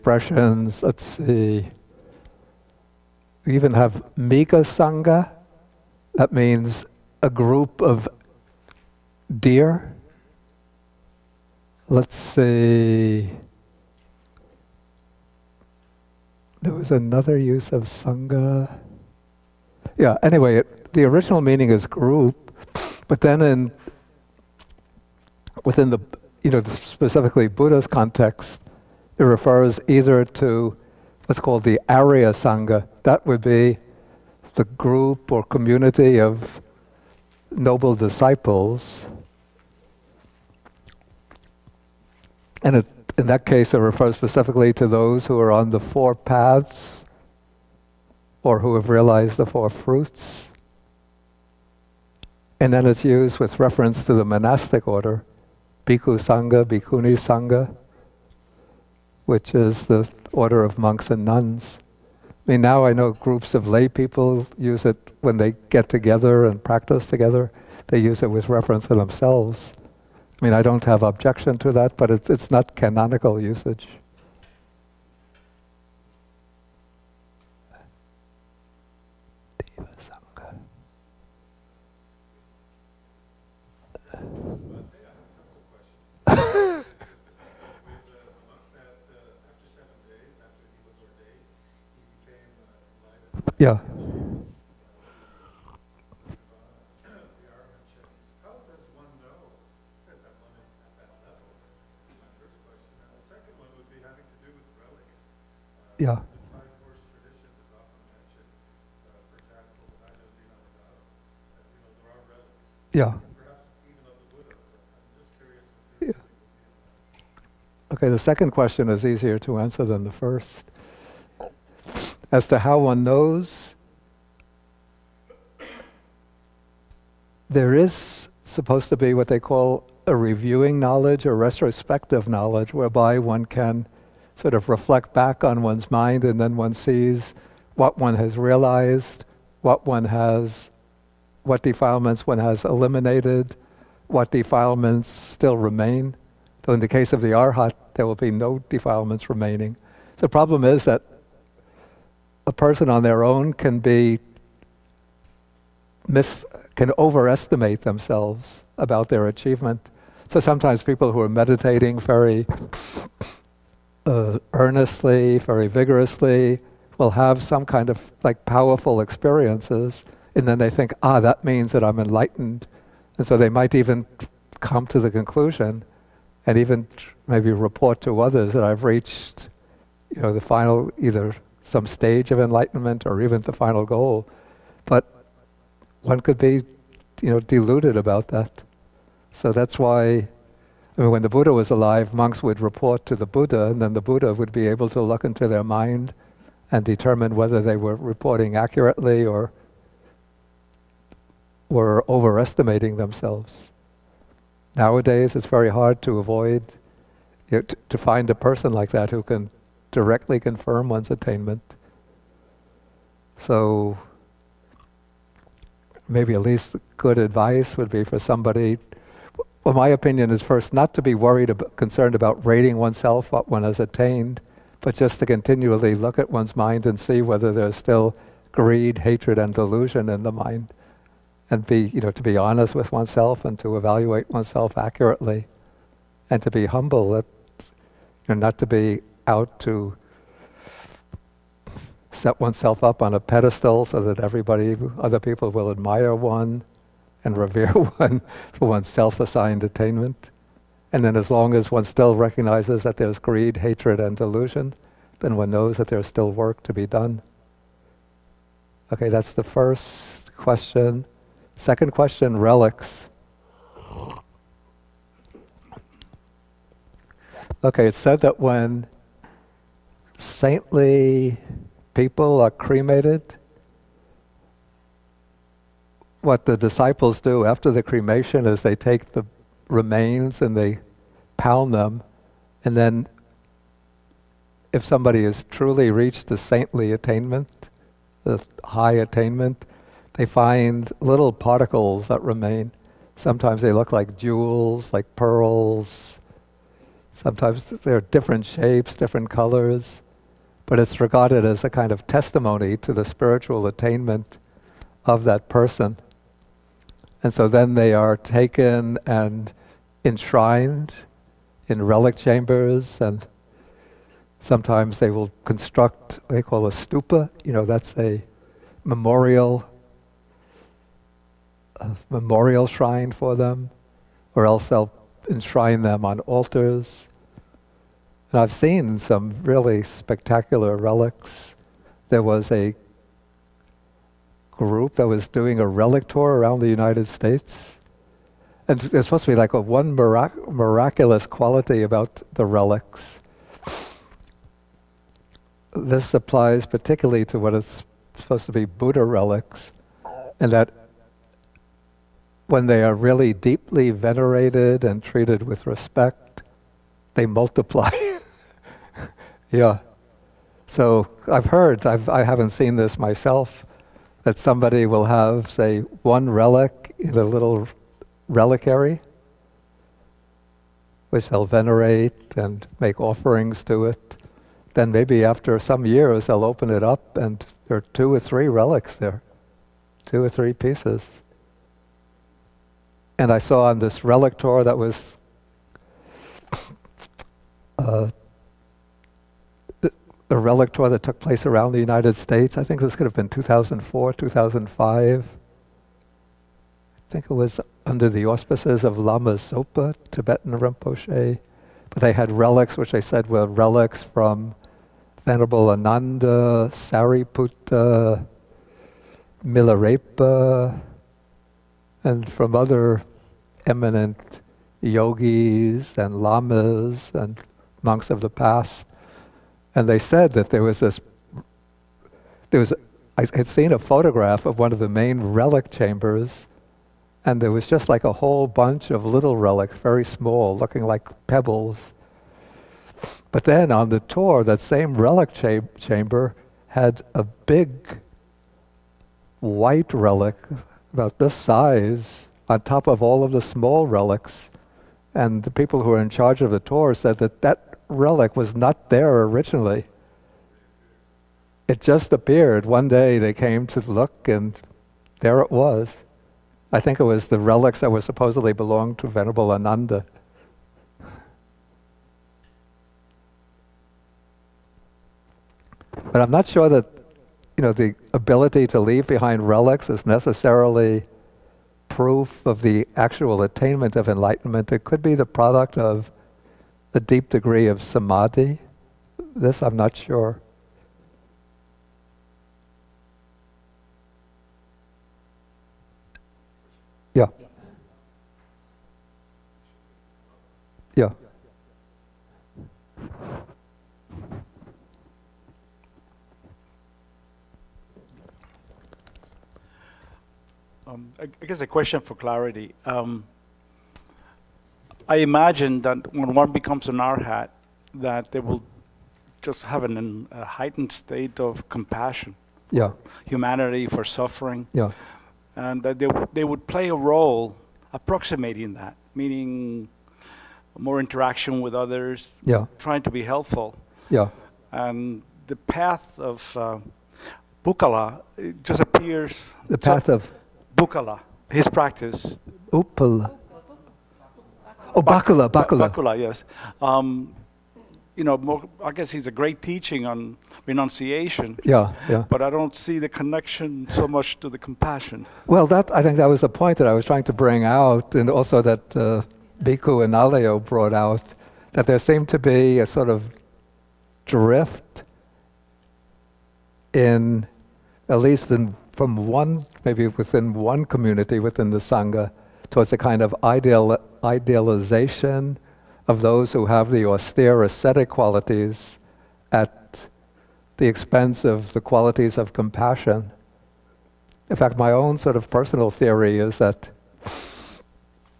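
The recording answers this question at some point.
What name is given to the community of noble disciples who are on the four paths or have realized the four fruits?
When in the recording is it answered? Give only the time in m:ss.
0:31.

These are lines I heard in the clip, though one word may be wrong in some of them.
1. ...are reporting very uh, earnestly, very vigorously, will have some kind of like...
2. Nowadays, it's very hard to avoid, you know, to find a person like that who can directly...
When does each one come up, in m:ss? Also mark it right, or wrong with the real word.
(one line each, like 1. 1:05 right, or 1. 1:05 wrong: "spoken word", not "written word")
1. 2:41 wrong: "meditating", not "reporting"
2. 3:24 right.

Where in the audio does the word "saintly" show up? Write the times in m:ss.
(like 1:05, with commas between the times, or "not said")
4:30, 4:46.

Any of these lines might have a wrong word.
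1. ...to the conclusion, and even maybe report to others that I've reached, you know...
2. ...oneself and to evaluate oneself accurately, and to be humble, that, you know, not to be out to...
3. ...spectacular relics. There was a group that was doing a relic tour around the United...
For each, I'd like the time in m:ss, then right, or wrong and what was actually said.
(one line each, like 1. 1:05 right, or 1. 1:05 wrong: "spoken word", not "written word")
1. 2:54 right
2. 3:52 right
3. 5:29 right.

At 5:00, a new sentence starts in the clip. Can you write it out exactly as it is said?
But it's regarded as a kind of testimony to the spiritual attainment of that person.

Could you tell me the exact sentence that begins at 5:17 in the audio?
You know, that's a memorial, a memorial shrine for them, or else they'll enshrine them on altars.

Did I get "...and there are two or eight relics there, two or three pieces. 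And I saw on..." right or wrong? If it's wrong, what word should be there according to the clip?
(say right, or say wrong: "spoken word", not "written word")
wrong: "three", not "eight".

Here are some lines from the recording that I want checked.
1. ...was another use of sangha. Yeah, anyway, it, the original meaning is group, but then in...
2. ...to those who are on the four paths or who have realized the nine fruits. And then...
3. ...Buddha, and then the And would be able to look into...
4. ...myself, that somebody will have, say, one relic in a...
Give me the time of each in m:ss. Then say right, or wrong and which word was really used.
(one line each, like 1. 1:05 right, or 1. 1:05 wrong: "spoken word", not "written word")
1. 0:16 right
2. 0:44 wrong: "four", not "nine"
3. 3:13 wrong: "Buddha", not "And"
4. 6:02 right.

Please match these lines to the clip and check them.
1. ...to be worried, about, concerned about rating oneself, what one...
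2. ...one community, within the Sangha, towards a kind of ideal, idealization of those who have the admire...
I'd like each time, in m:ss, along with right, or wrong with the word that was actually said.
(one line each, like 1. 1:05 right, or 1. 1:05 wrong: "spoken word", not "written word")
1. 3:40 right
2. 9:20 wrong: "austere", not "admire".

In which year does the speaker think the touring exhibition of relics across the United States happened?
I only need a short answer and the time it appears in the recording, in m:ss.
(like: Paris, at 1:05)
2004, at 6:33.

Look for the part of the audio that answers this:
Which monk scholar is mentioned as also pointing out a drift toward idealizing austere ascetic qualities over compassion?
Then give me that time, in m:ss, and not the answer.
9:09.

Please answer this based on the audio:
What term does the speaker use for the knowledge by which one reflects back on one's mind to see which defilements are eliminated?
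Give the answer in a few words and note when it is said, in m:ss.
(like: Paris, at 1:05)
reviewing knowledge, at 2:10.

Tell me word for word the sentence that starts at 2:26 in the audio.
So, in the case of the arhat, there will be no defilements remaining.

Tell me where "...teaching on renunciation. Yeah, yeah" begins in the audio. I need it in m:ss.
8:59.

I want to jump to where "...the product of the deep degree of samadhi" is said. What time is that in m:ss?
7:55.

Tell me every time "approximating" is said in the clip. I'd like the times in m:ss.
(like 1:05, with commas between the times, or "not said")
8:37.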